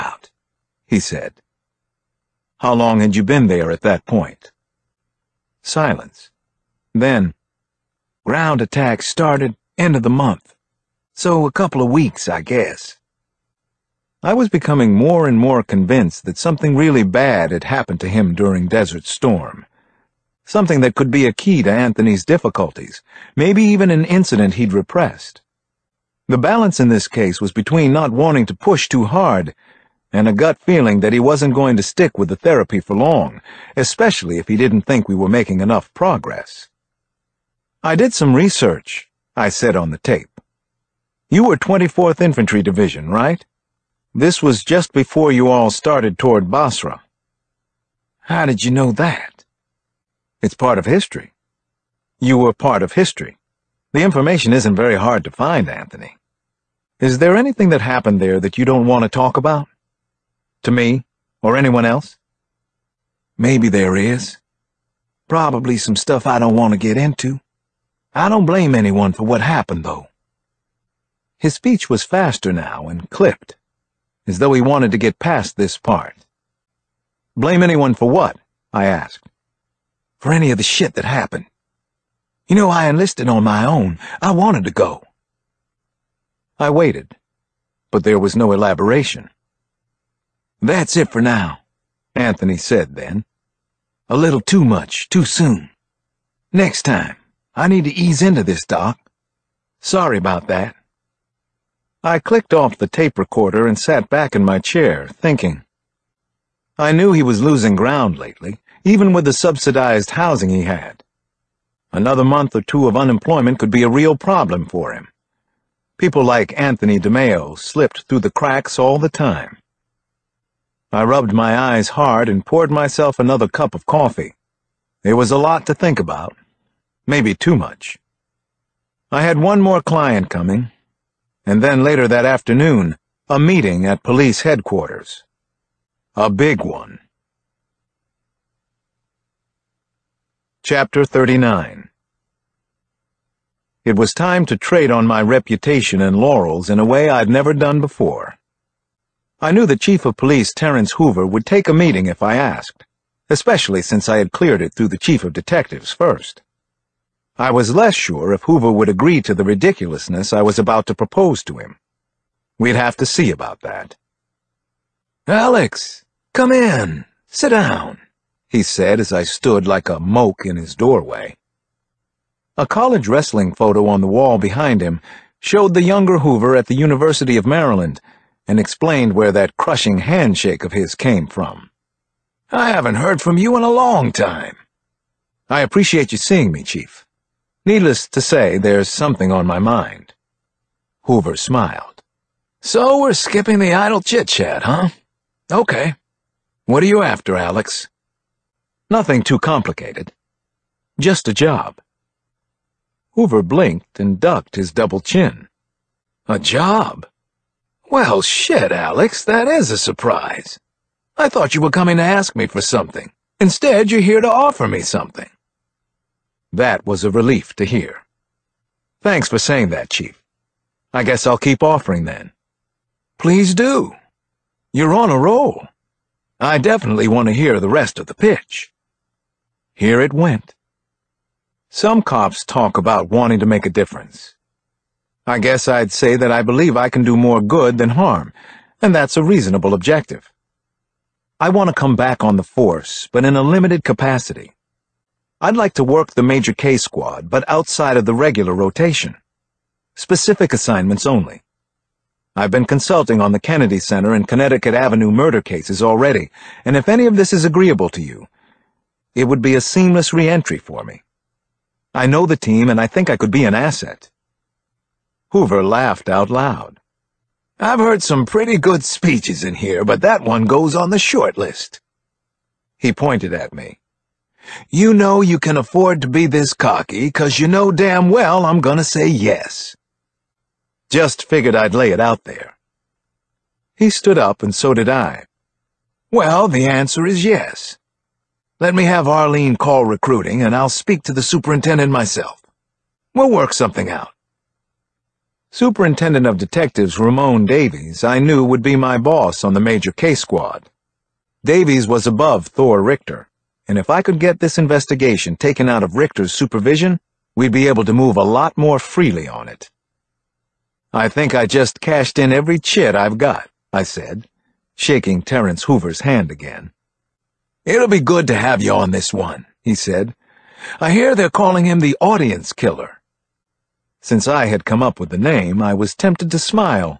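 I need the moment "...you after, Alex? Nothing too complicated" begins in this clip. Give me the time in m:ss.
3:16.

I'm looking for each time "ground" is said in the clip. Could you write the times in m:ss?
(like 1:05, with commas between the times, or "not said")
0:08, 1:47.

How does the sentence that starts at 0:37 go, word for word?
I did some research I said on the tape.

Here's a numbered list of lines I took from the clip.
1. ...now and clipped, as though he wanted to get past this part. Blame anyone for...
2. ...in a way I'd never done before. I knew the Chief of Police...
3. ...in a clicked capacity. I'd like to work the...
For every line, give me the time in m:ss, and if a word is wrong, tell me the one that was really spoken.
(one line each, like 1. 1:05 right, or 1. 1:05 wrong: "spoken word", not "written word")
1. 1:12 right
2. 2:26 right
3. 4:03 wrong: "limited", not "clicked".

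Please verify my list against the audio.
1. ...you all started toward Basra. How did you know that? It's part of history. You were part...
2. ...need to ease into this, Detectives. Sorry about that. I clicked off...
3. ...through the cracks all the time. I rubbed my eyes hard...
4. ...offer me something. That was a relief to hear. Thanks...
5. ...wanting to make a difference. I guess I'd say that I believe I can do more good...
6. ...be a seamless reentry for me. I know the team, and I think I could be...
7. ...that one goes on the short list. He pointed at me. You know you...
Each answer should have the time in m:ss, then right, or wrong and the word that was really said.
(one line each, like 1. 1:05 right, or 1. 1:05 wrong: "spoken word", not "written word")
1. 0:45 right
2. 1:37 wrong: "Doc", not "Detectives"
3. 1:58 right
4. 3:34 right
5. 3:53 right
6. 4:19 right
7. 4:30 right.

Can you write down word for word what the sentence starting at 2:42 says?
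We'd have to see about that.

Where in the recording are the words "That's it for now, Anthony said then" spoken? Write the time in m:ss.
1:30.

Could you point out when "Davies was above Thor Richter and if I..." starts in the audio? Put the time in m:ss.
5:01.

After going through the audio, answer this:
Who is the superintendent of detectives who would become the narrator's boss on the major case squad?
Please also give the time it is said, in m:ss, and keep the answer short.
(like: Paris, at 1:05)
Ramon Davies, at 4:56.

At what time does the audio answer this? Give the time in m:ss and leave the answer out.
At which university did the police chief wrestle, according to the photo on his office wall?
2:56.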